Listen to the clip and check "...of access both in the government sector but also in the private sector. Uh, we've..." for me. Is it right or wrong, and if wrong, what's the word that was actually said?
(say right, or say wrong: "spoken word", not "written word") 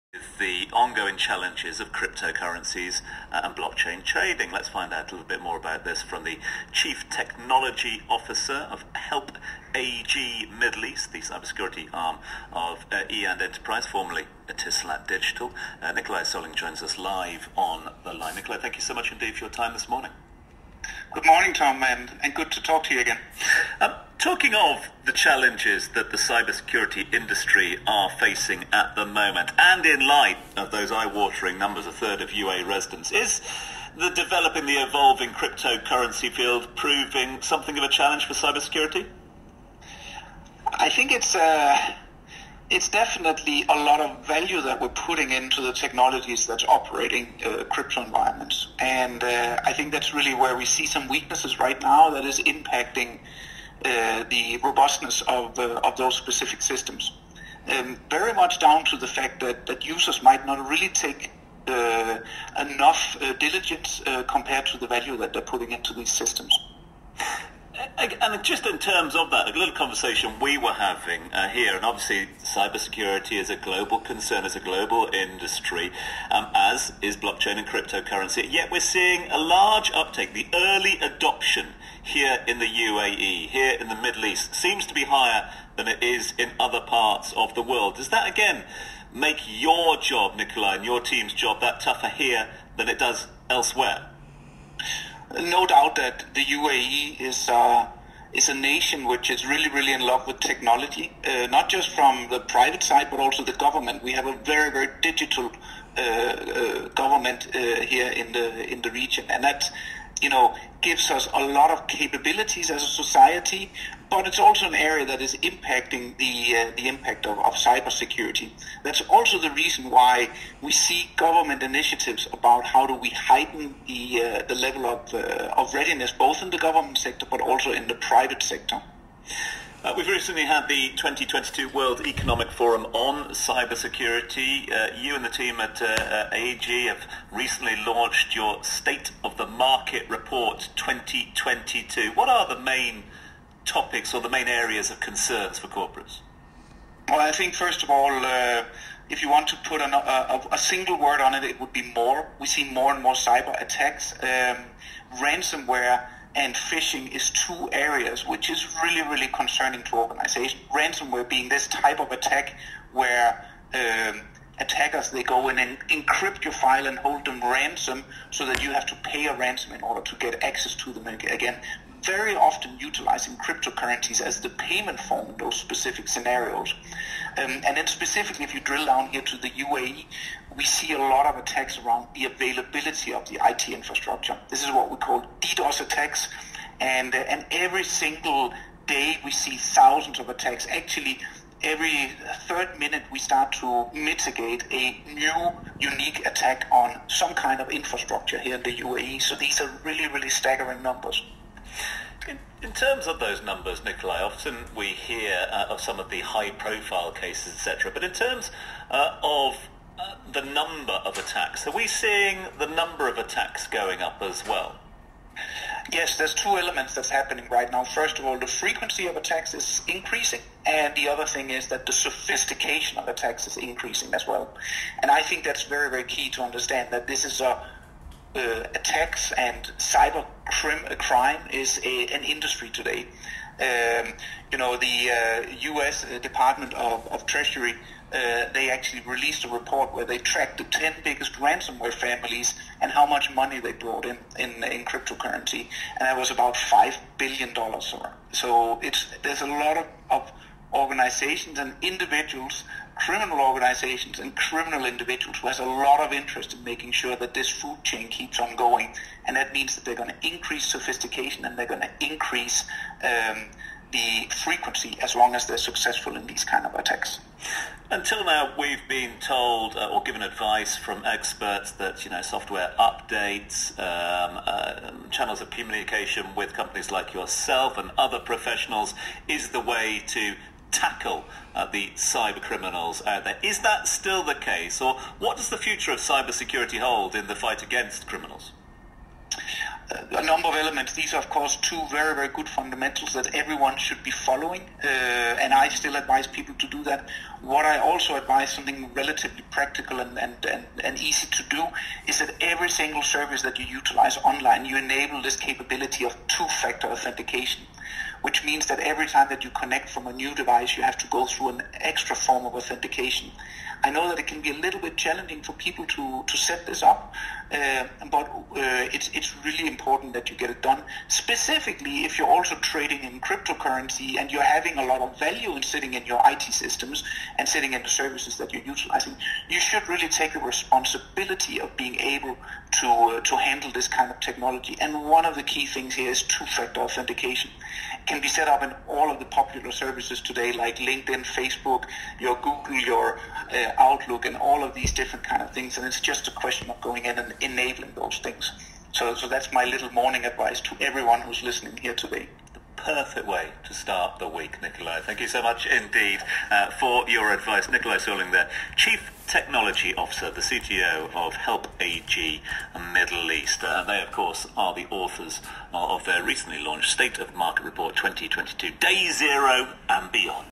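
wrong: "readiness", not "access".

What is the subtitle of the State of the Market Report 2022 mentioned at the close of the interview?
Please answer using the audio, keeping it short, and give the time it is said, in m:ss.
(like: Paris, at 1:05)
Day Zero and Beyond, at 6:08.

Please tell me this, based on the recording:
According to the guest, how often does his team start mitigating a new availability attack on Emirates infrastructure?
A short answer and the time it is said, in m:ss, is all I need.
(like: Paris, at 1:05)
every third minute, at 3:11.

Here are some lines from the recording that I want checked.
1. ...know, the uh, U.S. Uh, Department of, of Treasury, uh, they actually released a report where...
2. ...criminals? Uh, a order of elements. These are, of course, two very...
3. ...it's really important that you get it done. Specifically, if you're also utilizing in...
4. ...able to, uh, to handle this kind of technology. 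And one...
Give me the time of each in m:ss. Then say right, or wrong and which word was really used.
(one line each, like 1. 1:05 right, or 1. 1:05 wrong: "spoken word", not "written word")
1. 3:54 right
2. 4:48 wrong: "number", not "order"
3. 5:19 wrong: "trading", not "utilizing"
4. 5:31 right.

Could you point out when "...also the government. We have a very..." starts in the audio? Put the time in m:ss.
1:43.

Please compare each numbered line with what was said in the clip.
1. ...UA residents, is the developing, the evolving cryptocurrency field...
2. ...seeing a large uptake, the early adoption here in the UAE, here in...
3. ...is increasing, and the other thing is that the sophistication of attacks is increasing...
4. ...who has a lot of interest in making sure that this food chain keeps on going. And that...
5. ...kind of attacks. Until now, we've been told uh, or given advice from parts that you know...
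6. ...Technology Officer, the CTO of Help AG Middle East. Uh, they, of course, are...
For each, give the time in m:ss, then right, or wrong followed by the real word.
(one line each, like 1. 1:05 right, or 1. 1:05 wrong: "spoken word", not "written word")
1. 0:32 right
2. 1:18 right
3. 3:39 right
4. 4:15 right
5. 4:26 wrong: "experts", not "parts"
6. 5:59 right.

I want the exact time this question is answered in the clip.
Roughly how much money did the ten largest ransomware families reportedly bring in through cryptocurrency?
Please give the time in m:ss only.
4:06.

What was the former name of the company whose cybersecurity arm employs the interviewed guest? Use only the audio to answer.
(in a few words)
Etisalat Digital.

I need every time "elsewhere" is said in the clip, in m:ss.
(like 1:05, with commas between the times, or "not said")
1:33.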